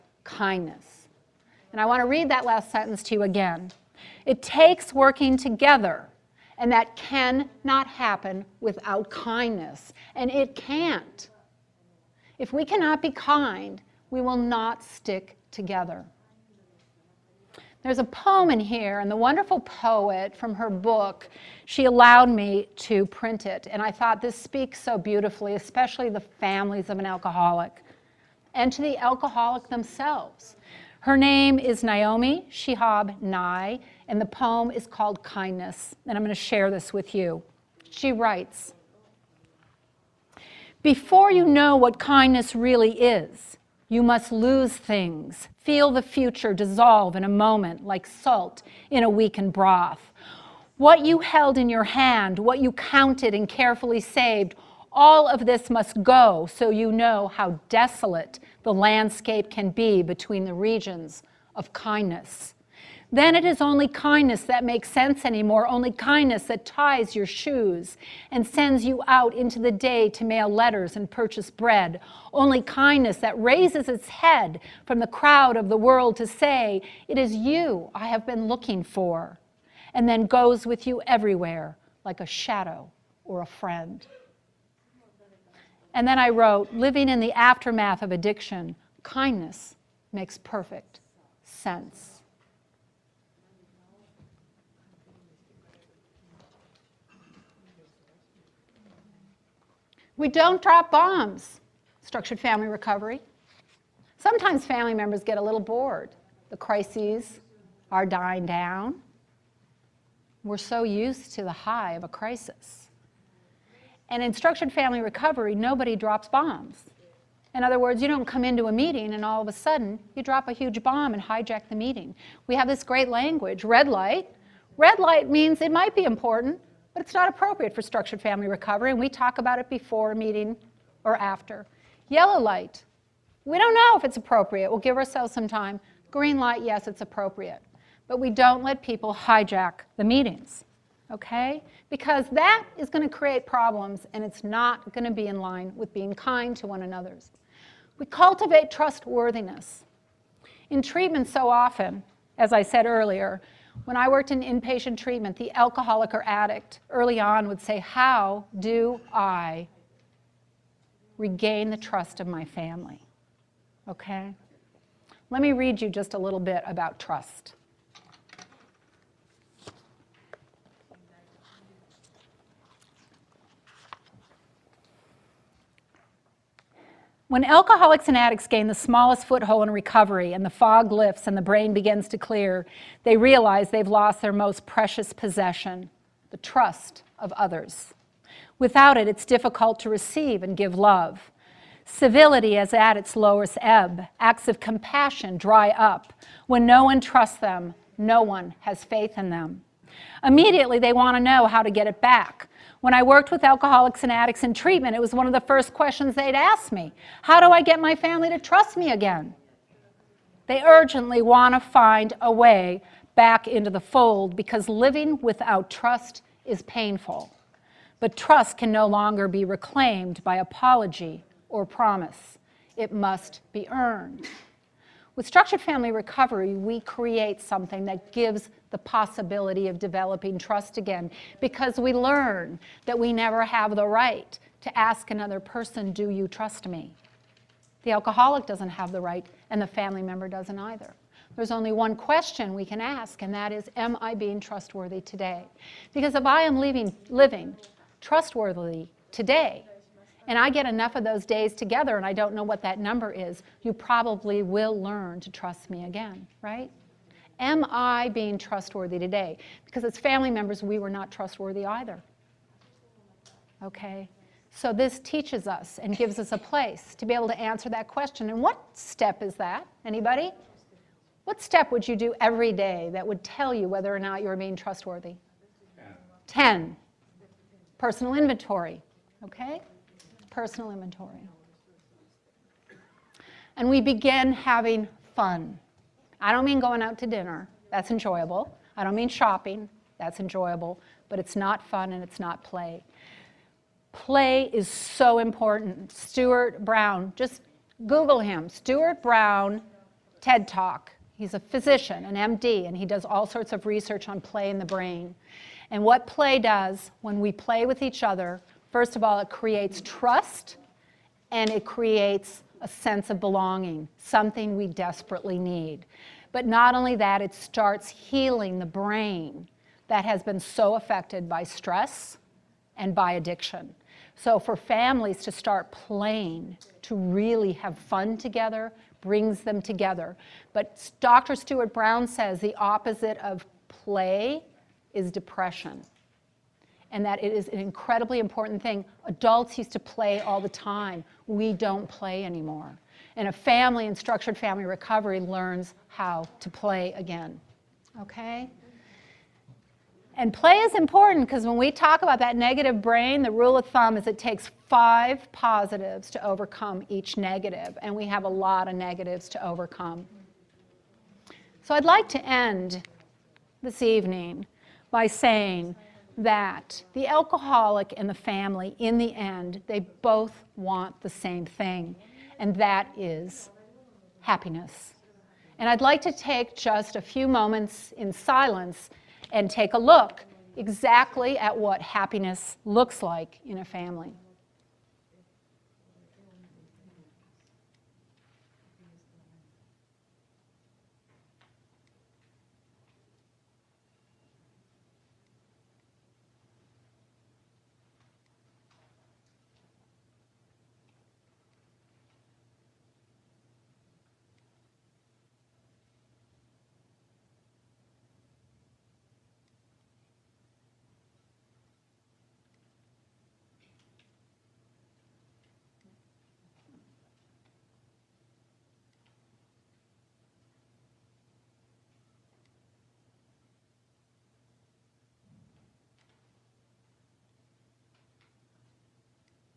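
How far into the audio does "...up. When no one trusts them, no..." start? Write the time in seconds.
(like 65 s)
195 s.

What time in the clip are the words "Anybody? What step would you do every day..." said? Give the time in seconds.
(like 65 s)
269 s.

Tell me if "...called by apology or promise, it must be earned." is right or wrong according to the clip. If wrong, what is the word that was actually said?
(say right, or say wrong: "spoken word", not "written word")
wrong: "reclaimed", not "called".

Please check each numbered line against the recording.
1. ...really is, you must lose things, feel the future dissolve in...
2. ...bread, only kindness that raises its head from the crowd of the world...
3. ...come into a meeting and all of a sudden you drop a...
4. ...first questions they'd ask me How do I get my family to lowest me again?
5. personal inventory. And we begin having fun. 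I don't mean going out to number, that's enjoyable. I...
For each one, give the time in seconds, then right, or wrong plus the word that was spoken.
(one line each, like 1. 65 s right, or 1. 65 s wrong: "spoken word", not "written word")
1. 42 s right
2. 71 s right
3. 118 s right
4. 205 s wrong: "trust", not "lowest"
5. 280 s wrong: "dinner", not "number".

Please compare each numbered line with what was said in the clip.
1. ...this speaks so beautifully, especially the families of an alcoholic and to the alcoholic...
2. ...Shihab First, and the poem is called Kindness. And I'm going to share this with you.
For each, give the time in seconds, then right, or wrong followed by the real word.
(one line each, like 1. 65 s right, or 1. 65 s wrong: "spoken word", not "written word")
1. 24 s right
2. 32 s wrong: "Nye", not "First".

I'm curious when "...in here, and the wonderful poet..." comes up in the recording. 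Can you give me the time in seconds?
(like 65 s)
18 s.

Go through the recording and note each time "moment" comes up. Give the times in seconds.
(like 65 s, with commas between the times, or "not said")
47 s, 377 s.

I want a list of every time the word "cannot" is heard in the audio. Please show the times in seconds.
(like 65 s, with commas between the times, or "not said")
6 s, 12 s.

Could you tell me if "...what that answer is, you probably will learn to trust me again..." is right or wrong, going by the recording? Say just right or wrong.
wrong.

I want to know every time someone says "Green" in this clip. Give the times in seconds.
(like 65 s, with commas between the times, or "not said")
136 s.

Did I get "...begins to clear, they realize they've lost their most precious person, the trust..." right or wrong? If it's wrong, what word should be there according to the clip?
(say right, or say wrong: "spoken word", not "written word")
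wrong: "possession", not "person".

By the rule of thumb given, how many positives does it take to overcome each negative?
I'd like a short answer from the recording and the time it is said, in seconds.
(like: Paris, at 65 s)
5, at 354 s.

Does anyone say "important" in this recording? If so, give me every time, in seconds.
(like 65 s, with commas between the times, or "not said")
126 s, 295 s, 338 s, 350 s.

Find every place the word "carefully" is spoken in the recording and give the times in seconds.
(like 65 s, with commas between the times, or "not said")
53 s.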